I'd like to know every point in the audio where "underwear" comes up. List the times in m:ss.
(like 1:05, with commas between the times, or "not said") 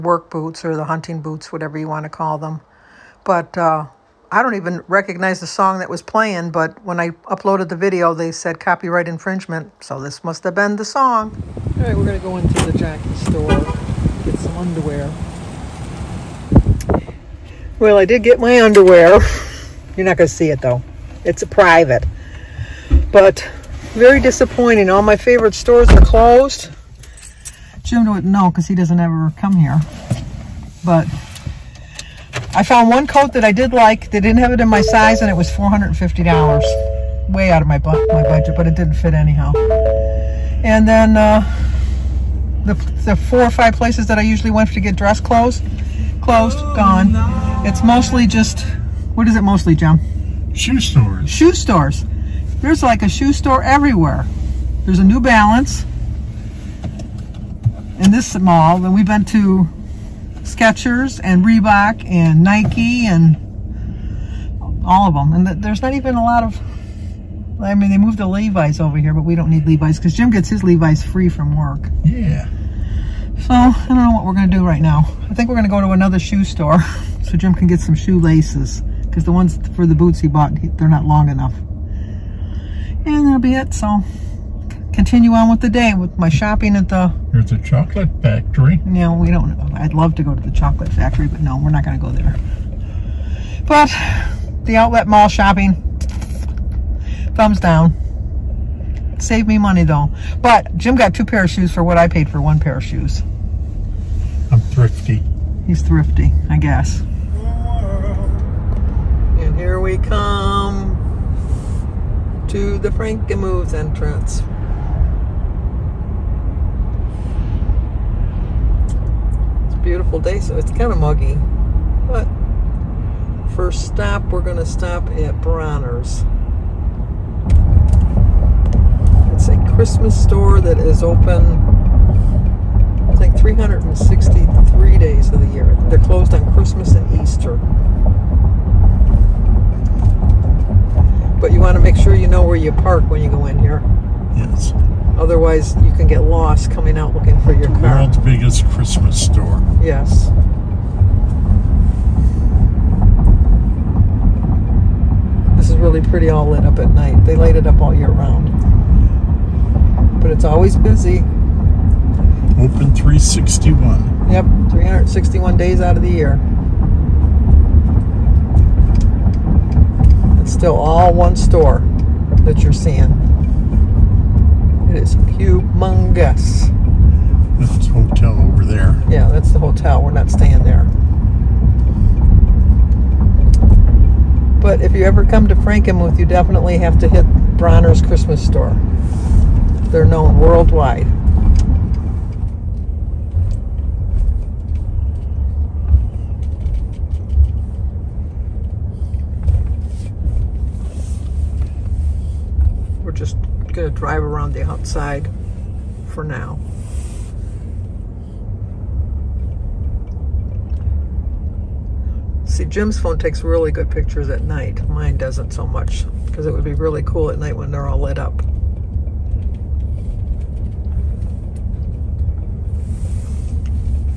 0:14, 0:18.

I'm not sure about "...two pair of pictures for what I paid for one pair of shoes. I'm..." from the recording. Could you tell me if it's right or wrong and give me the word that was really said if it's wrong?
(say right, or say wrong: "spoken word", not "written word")
wrong: "shoes", not "pictures".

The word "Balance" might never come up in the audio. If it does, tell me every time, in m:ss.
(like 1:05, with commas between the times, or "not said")
0:55.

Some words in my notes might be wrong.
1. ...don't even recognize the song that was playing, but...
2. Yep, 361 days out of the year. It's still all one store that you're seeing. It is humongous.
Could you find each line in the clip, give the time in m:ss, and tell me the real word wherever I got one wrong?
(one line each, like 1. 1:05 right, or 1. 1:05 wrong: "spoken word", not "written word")
1. 0:04 right
2. 2:44 right.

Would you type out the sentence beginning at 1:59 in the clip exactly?
beautiful day, so it's kind of muggy.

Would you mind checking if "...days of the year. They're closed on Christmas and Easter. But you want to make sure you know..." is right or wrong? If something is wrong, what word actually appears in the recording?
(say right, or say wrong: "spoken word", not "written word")
right.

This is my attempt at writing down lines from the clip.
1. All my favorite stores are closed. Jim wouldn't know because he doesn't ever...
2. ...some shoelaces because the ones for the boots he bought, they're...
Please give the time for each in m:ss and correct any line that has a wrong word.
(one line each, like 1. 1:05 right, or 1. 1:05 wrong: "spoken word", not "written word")
1. 0:24 right
2. 1:17 right.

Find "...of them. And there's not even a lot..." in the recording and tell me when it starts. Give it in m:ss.
1:05.